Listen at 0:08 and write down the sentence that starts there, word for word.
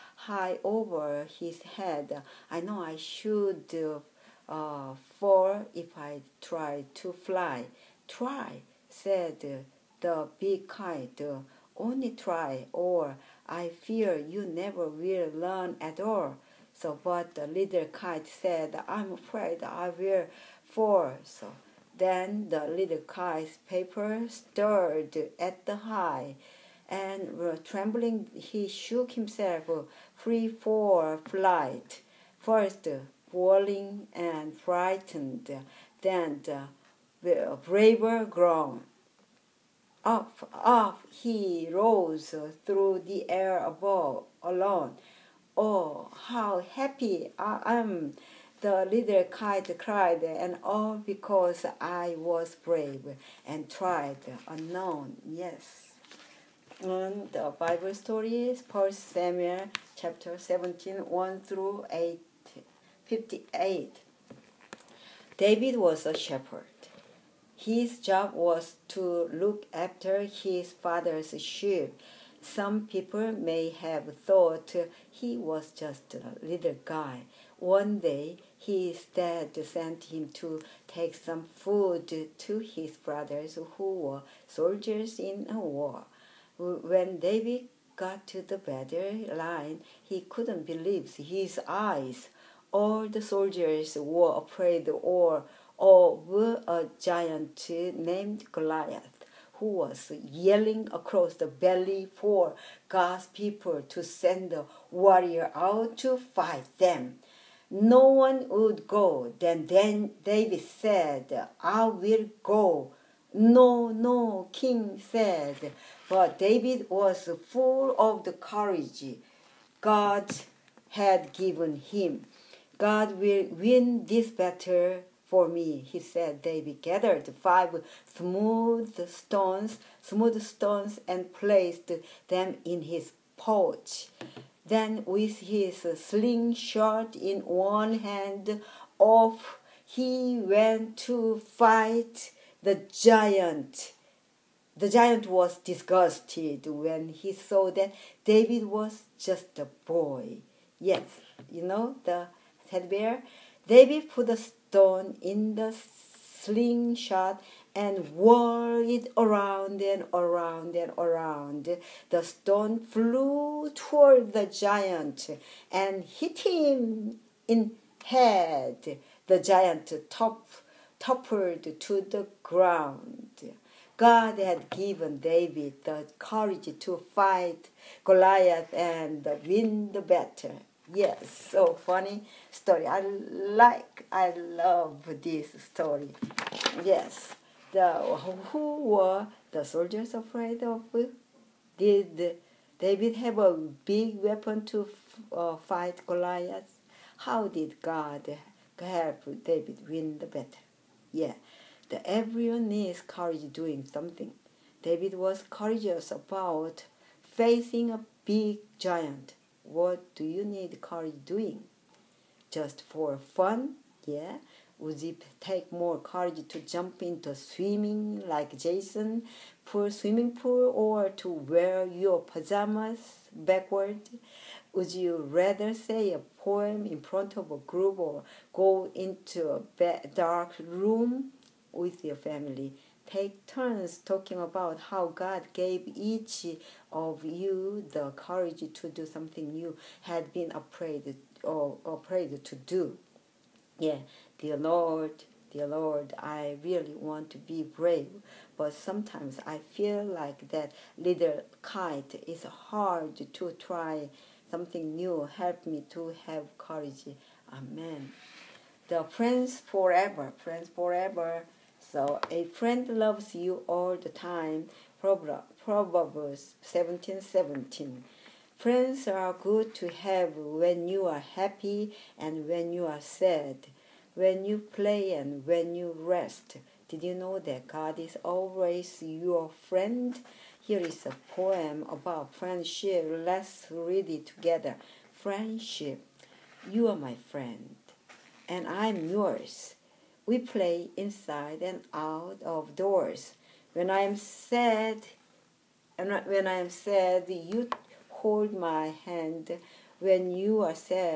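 Try, said the big kite only try, or I fear you never will learn at all.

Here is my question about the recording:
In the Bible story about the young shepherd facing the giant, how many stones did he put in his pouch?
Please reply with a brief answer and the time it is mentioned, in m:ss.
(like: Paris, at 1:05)
5, at 2:07.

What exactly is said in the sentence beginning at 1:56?
But David was full of the courage God had given him.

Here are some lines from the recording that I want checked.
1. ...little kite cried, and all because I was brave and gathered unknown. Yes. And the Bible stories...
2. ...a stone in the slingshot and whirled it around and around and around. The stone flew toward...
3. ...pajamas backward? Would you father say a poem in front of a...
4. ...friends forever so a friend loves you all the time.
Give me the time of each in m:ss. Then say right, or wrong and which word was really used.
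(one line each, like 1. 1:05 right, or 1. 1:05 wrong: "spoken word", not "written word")
1. 0:48 wrong: "tried", not "gathered"
2. 2:34 right
3. 3:42 wrong: "rather", not "father"
4. 4:20 right.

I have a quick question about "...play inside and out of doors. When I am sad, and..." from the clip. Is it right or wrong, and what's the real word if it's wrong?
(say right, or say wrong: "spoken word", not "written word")
right.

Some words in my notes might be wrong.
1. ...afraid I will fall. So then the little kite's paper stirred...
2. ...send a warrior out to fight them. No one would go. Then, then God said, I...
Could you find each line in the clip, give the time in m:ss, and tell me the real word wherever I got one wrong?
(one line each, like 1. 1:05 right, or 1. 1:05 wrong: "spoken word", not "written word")
1. 0:19 right
2. 1:44 wrong: "David", not "God".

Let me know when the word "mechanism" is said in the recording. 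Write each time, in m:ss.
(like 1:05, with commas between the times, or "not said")
not said.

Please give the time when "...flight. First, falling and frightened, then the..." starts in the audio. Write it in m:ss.
0:31.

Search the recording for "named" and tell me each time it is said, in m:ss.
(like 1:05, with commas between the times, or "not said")
1:37.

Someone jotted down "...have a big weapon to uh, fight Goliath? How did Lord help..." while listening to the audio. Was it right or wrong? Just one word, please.
wrong.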